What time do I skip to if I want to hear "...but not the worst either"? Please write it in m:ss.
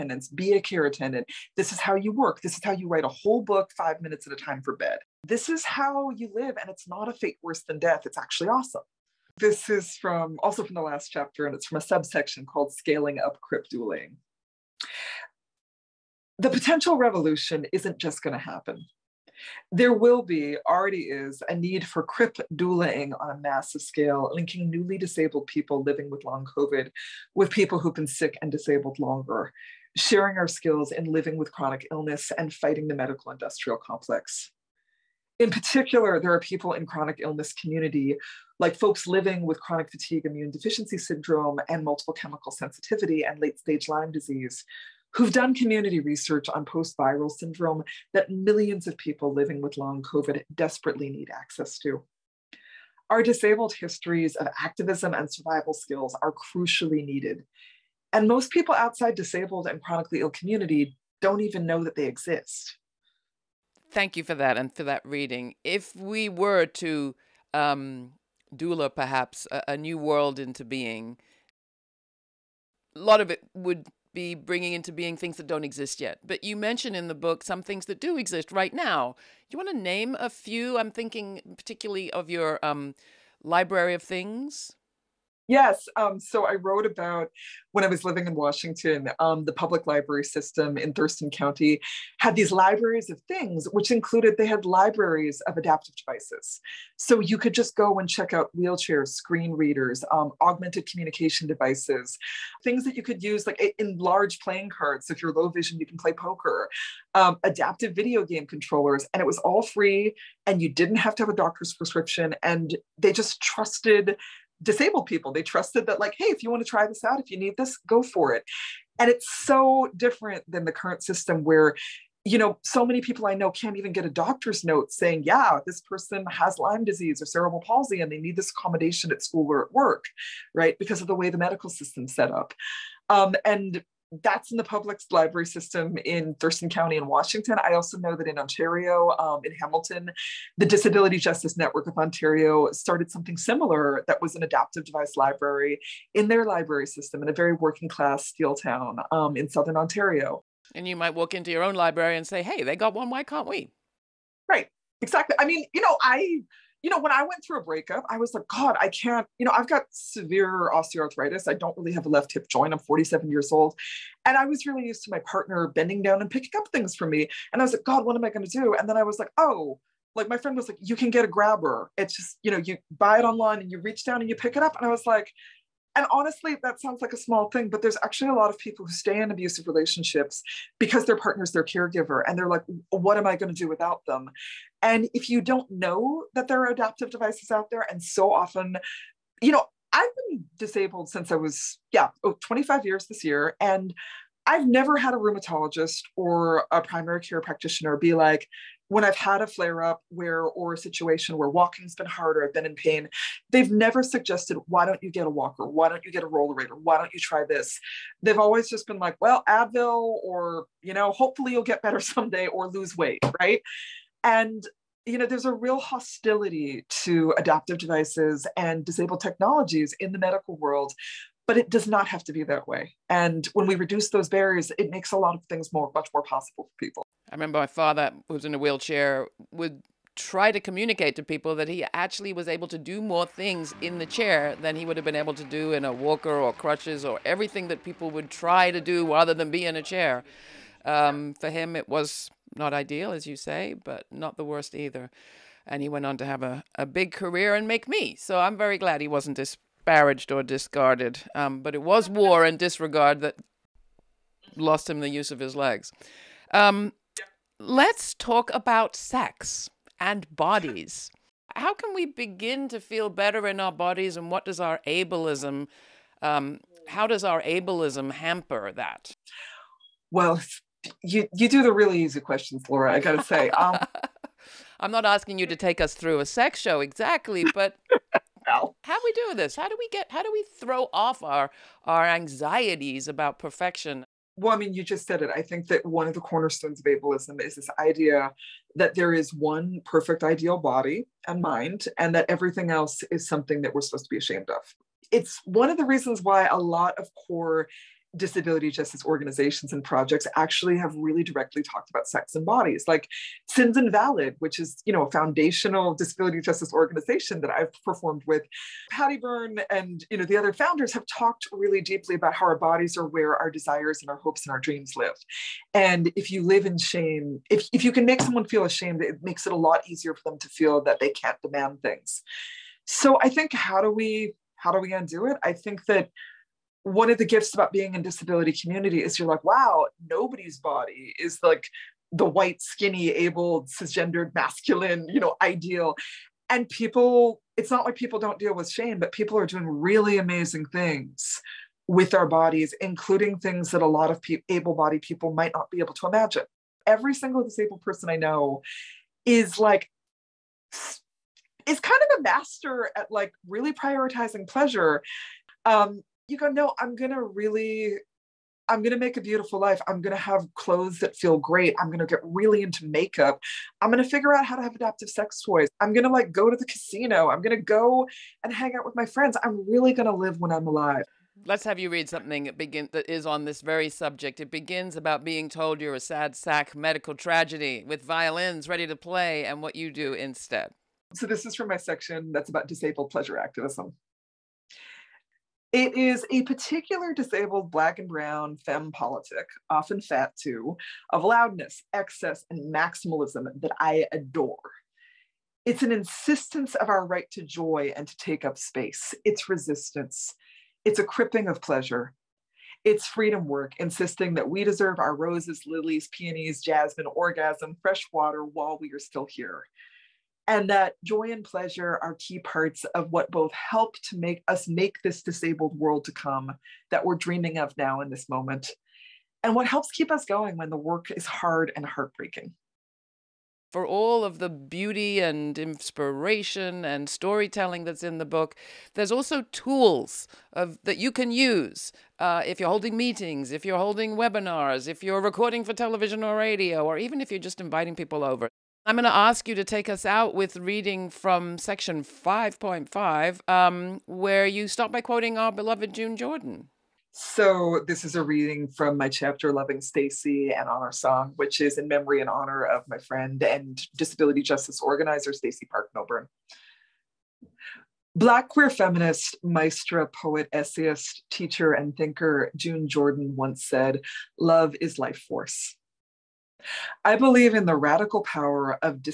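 4:03.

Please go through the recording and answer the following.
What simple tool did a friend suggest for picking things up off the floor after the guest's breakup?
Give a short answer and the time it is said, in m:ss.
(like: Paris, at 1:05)
A grabber, at 2:51.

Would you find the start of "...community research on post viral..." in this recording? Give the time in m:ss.
0:45.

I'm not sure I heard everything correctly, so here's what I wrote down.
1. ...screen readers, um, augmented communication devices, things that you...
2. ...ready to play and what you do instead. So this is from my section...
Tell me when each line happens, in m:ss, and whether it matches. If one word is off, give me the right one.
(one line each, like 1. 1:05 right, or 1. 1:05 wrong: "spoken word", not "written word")
1. 1:39 right
2. 6:18 right.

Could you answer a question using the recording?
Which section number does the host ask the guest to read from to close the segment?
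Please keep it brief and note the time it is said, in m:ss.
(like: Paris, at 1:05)
5.5, at 7:21.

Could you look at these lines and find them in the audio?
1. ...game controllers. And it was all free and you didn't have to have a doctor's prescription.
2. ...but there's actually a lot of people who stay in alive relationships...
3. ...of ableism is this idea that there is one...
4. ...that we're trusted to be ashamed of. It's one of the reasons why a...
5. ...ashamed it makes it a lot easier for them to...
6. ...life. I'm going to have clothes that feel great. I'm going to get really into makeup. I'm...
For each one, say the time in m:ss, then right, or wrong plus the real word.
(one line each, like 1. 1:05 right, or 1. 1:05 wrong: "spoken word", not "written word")
1. 1:48 right
2. 2:57 wrong: "abusive", not "alive"
3. 4:46 right
4. 4:53 wrong: "supposed", not "trusted"
5. 5:18 right
6. 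5:59 right.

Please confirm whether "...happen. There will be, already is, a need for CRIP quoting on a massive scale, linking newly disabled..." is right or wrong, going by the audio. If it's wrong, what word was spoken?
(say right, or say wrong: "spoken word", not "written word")
wrong: "doulaing", not "quoting".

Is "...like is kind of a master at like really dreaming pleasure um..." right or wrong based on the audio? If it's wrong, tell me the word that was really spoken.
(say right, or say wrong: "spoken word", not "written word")
wrong: "prioritizing", not "dreaming".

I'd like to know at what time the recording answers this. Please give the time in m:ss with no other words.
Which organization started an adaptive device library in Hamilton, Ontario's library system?
2:20.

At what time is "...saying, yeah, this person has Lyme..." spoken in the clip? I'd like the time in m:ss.
2:04.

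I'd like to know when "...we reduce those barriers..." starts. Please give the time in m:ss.
3:43.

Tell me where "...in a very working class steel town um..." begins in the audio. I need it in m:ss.
2:27.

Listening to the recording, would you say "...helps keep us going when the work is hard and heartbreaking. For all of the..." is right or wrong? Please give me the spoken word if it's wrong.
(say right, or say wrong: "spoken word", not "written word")
right.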